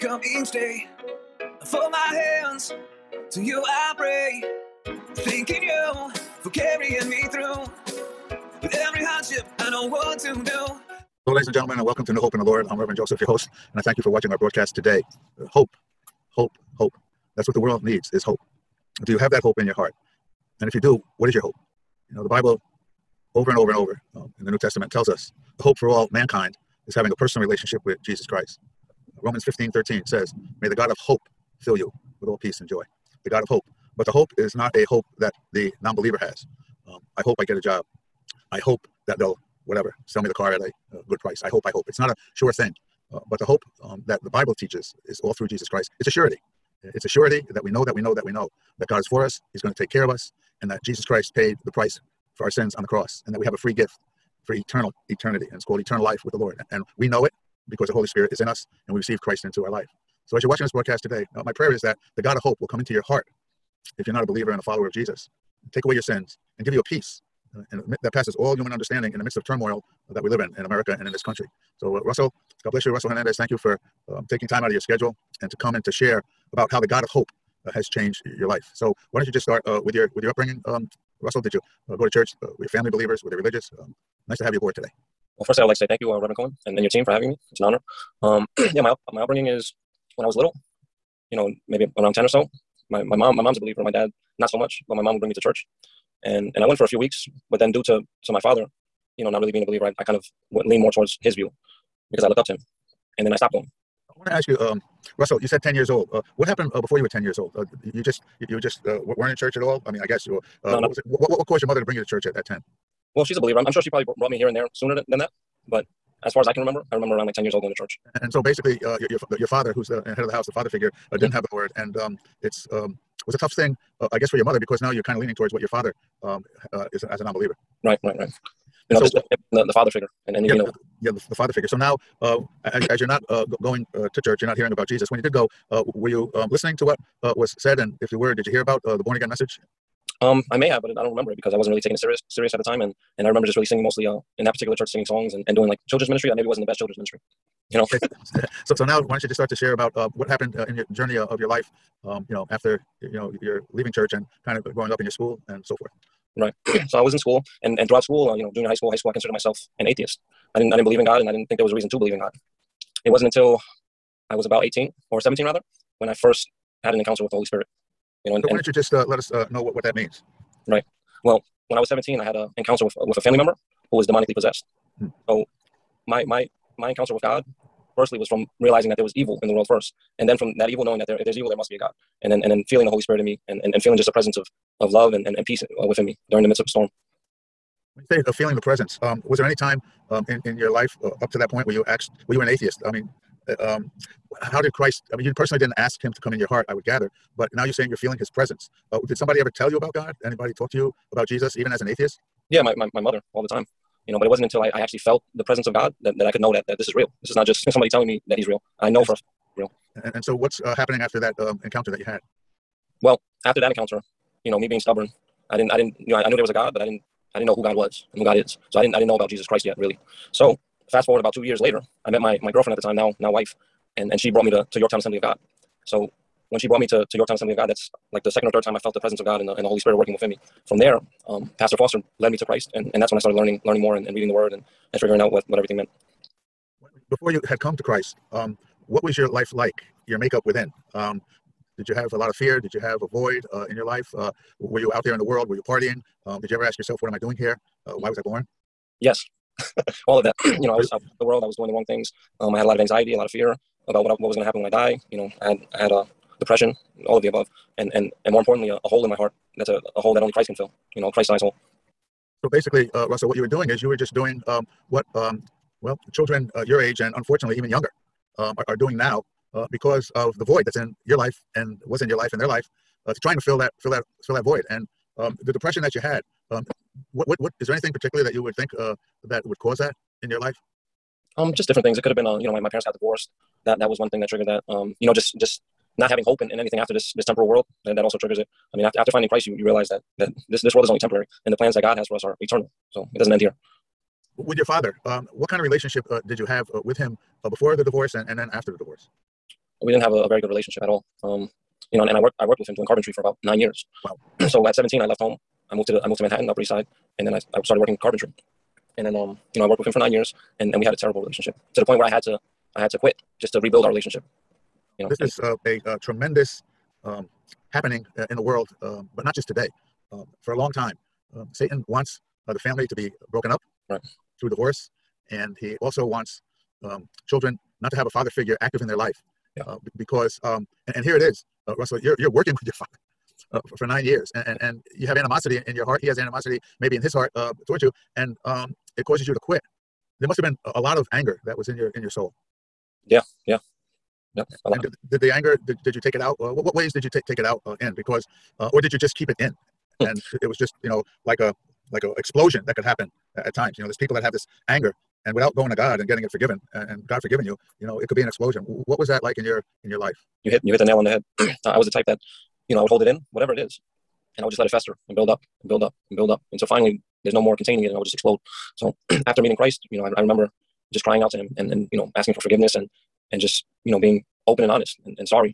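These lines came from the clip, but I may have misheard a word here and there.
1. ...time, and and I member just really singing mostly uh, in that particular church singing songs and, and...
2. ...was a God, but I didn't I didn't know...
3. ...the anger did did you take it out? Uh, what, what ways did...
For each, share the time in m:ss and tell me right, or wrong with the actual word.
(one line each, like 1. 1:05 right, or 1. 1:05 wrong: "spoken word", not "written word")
1. 2:22 wrong: "remember", not "member"
2. 3:36 right
3. 5:45 right.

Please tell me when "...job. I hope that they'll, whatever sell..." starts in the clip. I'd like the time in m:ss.
0:37.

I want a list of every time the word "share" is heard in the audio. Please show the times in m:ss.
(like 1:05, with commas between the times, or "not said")
1:15, 2:29.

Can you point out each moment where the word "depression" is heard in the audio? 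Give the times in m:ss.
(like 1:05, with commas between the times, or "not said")
4:16, 4:35.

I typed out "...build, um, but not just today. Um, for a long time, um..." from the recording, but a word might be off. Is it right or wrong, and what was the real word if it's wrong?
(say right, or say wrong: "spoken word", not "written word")
wrong: "world", not "build".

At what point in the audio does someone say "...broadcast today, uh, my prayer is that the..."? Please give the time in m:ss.
1:00.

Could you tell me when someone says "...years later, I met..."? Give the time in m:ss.
3:41.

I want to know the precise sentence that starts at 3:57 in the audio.
Before you had come to Christ, um, what was your life like?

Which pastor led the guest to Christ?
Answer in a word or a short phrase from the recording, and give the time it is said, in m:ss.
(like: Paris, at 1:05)
Pastor Foster, at 3:51.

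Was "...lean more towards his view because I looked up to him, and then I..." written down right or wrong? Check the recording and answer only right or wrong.
right.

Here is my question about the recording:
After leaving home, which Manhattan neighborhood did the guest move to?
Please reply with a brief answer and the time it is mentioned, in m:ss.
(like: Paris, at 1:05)
Upper East Side, at 5:06.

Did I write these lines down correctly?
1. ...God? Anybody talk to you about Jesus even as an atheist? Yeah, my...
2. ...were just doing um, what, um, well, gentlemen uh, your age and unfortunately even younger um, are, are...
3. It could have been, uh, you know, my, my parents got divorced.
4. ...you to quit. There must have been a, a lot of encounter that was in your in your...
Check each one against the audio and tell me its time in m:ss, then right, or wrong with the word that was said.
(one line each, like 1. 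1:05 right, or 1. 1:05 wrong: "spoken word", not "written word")
1. 3:19 right
2. 4:23 wrong: "children", not "gentlemen"
3. 4:41 right
4. 5:39 wrong: "anger", not "encounter".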